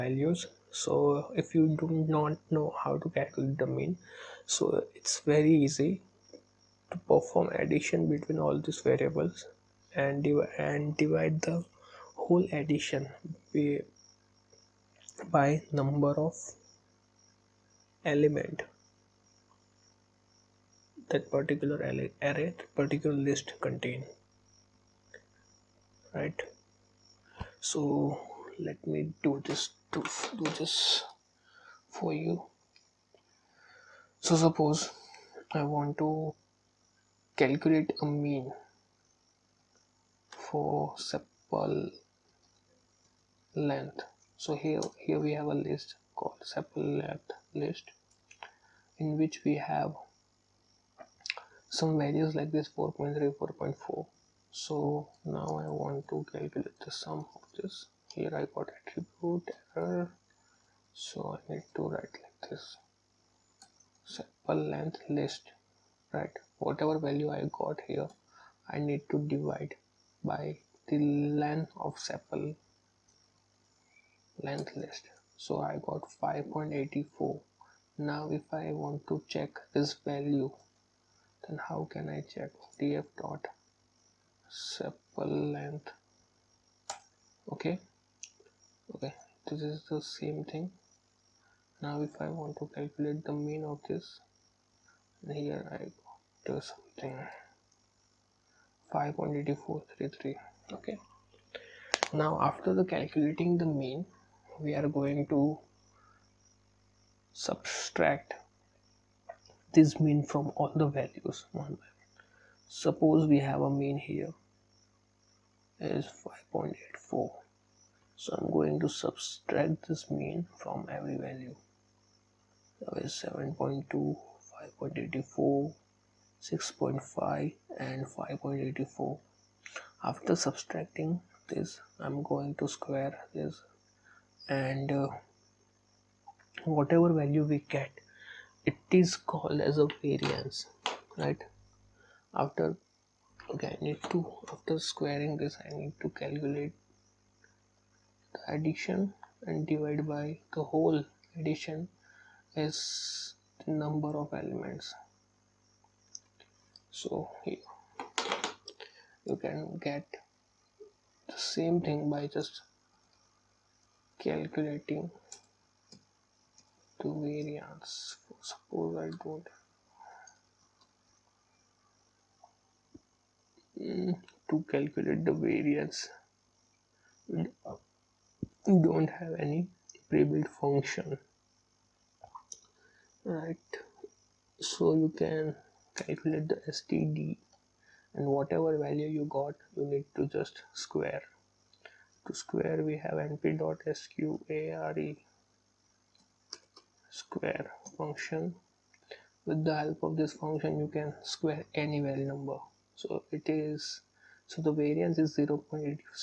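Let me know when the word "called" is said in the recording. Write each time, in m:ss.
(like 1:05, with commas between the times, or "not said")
0:46, 2:19.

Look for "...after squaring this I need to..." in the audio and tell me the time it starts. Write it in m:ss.
2:24.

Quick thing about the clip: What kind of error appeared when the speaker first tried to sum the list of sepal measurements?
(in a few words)
attribute error.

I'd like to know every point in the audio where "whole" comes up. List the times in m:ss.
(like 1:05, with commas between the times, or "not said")
0:12, 2:30.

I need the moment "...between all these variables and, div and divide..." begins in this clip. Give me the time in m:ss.
0:08.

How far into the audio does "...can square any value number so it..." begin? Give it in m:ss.
3:20.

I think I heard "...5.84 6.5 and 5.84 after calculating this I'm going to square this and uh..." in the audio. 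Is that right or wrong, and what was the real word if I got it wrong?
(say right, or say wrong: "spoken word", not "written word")
wrong: "subtracting", not "calculating".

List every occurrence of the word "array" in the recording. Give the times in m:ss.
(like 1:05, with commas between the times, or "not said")
0:21.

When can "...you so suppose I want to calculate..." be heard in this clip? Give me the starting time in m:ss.
0:32.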